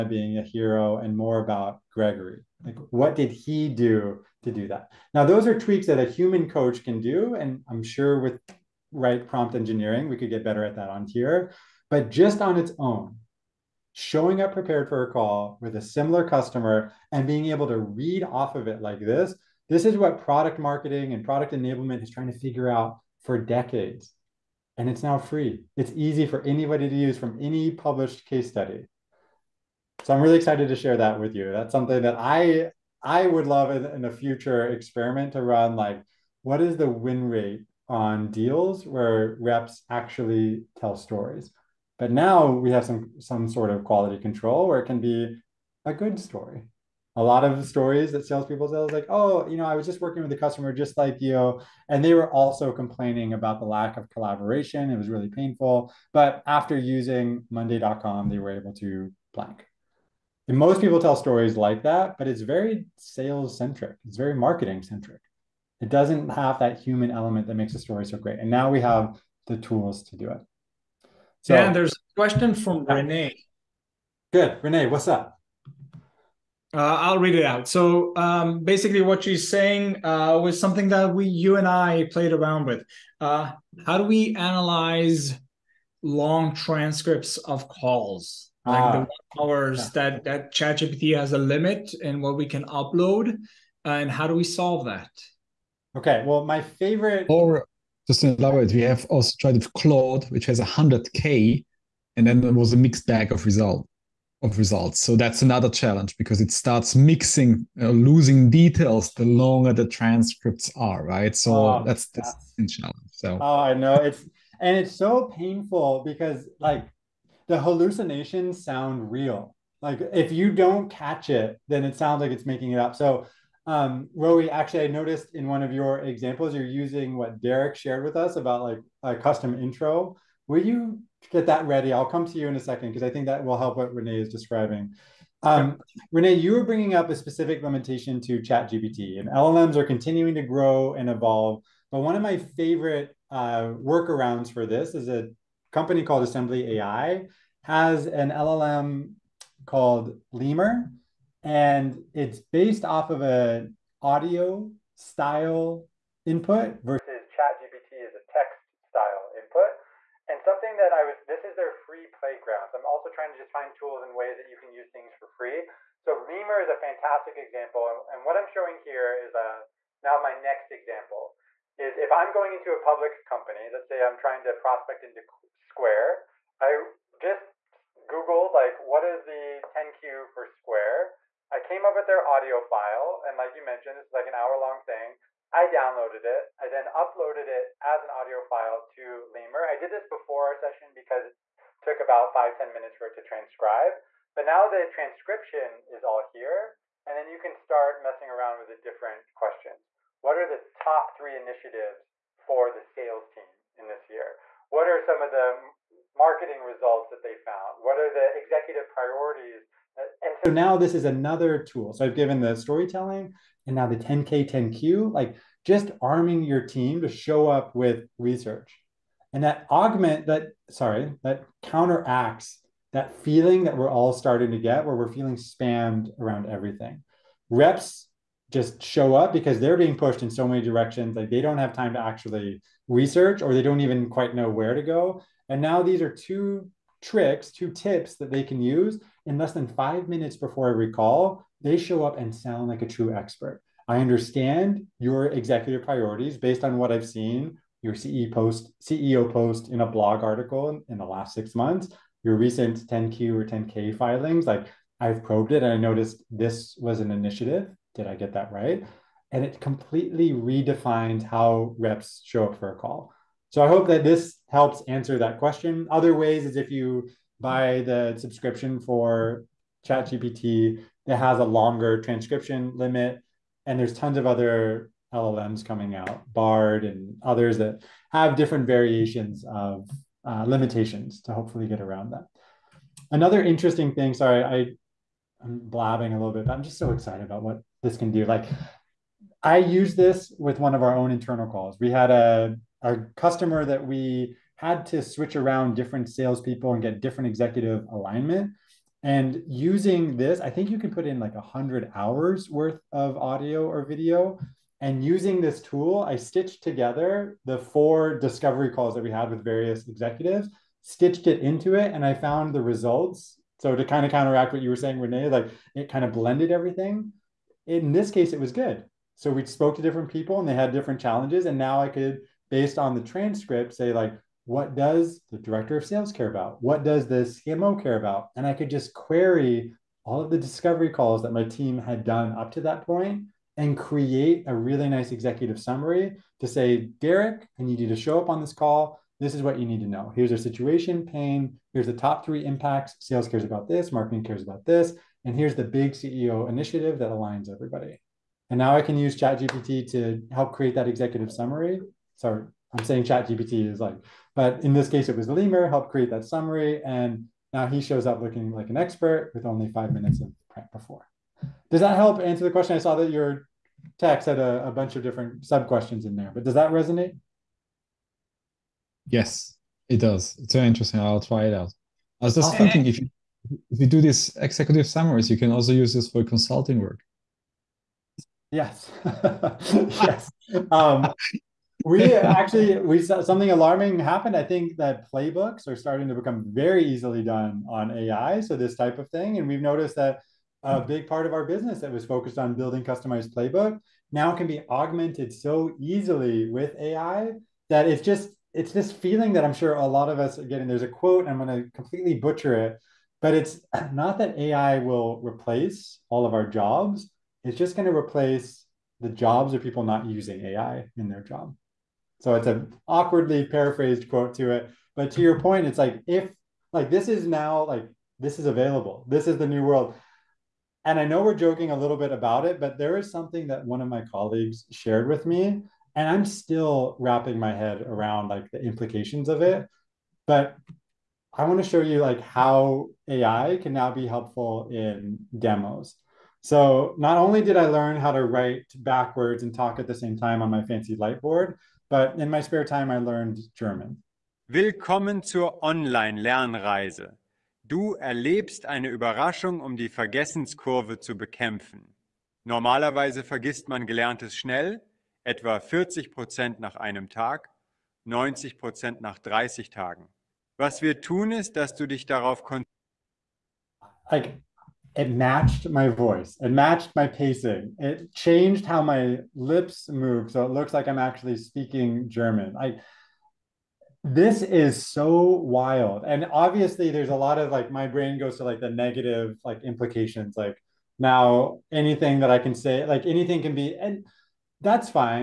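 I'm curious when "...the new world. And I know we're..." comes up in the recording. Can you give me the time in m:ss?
6:59.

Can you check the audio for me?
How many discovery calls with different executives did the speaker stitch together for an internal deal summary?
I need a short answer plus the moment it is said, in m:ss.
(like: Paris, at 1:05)
4, at 5:07.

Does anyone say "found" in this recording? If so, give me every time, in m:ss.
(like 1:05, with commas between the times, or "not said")
3:27, 5:12.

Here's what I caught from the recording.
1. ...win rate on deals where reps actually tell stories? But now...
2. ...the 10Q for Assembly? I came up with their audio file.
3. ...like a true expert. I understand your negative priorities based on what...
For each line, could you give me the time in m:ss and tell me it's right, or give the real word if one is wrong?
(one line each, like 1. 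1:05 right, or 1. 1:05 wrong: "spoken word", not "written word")
1. 0:36 right
2. 2:59 wrong: "Square", not "Assembly"
3. 4:02 wrong: "executive", not "negative".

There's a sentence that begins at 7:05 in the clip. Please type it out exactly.
And I'm still wrapping my head around like the implications of it.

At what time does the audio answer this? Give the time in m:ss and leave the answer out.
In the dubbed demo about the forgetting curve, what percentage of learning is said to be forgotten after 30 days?
7:38.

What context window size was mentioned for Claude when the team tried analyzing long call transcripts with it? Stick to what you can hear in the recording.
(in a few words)
100K.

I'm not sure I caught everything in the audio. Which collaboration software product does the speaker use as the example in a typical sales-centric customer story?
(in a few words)
Monday.com.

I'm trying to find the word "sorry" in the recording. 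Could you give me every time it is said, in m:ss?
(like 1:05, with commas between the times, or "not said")
3:40, 4:44, 5:52.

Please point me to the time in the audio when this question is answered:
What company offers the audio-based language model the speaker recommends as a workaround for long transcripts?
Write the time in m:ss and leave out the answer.
2:26.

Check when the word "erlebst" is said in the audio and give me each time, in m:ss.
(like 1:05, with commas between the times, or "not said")
7:27.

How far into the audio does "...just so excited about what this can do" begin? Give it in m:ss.
4:46.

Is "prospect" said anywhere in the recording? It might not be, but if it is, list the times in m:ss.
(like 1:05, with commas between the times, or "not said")
2:54.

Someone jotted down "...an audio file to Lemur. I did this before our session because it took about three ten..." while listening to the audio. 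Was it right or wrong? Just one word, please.
wrong.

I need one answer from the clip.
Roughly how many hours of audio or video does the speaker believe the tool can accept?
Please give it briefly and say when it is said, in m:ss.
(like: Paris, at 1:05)
100 hours, at 5:01.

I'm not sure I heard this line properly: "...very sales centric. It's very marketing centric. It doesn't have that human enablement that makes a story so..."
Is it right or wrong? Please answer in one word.
wrong.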